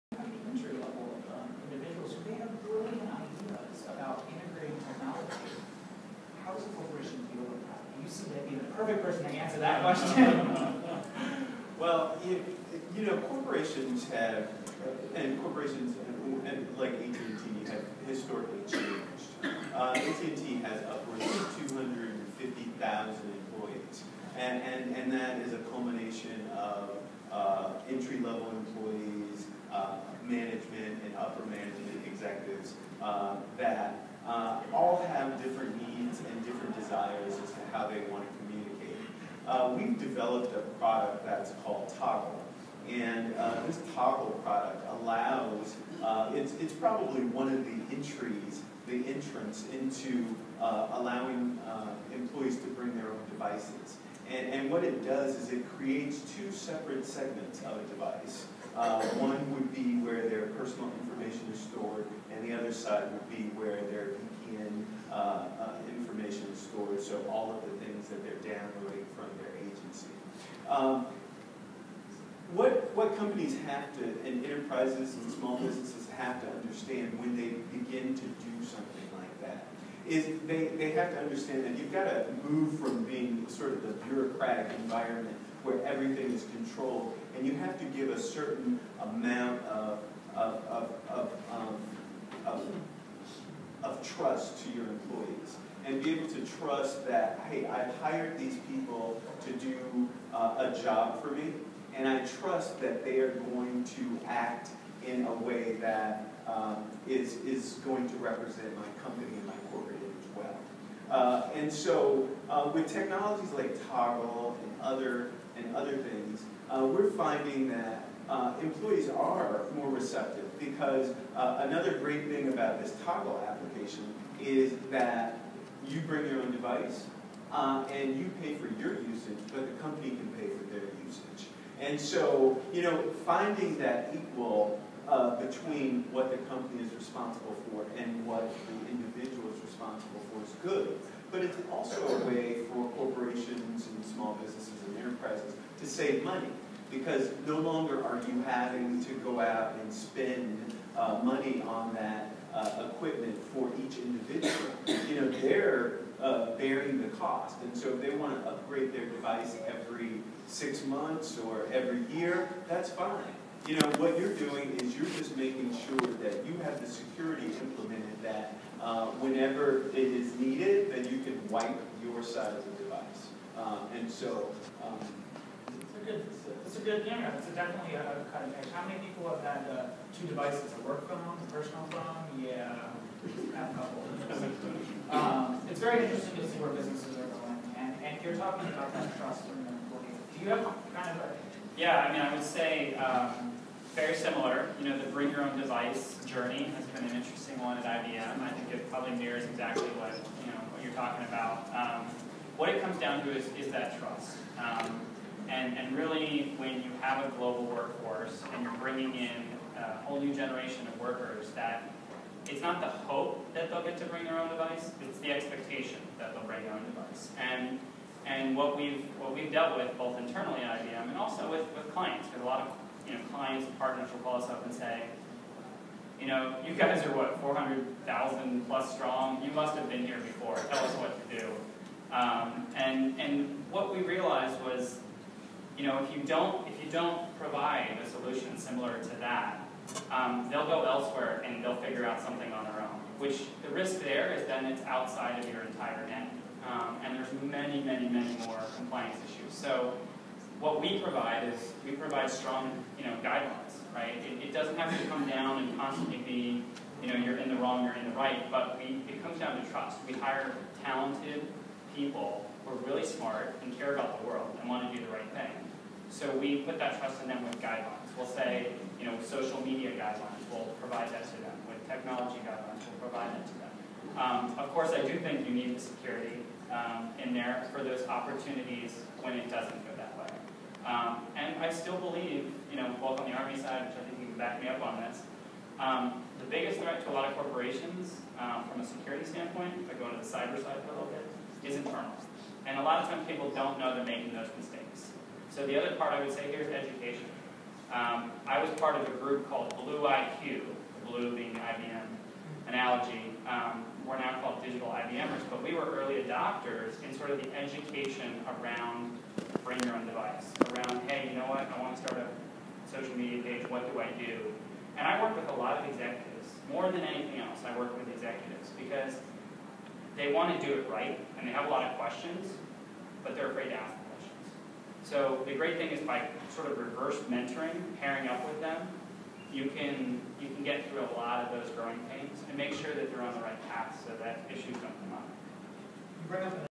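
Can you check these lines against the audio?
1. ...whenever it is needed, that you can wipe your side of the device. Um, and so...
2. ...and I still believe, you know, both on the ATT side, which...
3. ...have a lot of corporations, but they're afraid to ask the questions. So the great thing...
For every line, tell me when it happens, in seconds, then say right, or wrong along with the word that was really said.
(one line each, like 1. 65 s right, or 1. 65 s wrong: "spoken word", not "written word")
1. 169 s right
2. 281 s wrong: "Army", not "ATT"
3. 321 s wrong: "questions", not "corporations".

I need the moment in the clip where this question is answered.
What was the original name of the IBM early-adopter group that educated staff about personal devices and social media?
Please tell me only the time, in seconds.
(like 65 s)
299 s.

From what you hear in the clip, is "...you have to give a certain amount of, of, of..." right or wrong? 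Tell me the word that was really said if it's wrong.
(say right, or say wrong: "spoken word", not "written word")
right.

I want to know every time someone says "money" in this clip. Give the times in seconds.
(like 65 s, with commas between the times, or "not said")
146 s, 151 s.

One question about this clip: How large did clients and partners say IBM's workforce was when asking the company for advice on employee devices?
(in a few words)
400,000 plus.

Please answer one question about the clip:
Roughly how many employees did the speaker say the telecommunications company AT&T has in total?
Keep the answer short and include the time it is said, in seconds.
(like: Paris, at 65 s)
250,000, at 21 s.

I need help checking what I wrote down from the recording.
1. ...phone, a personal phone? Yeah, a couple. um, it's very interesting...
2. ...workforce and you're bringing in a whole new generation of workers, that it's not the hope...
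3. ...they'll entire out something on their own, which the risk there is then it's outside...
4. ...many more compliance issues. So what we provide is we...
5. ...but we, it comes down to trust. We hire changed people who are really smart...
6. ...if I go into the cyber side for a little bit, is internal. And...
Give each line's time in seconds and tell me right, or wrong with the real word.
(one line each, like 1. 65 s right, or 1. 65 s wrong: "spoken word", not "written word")
1. 181 s right
2. 207 s right
3. 241 s wrong: "figure", not "entire"
4. 248 s right
5. 258 s wrong: "talented", not "changed"
6. 289 s right.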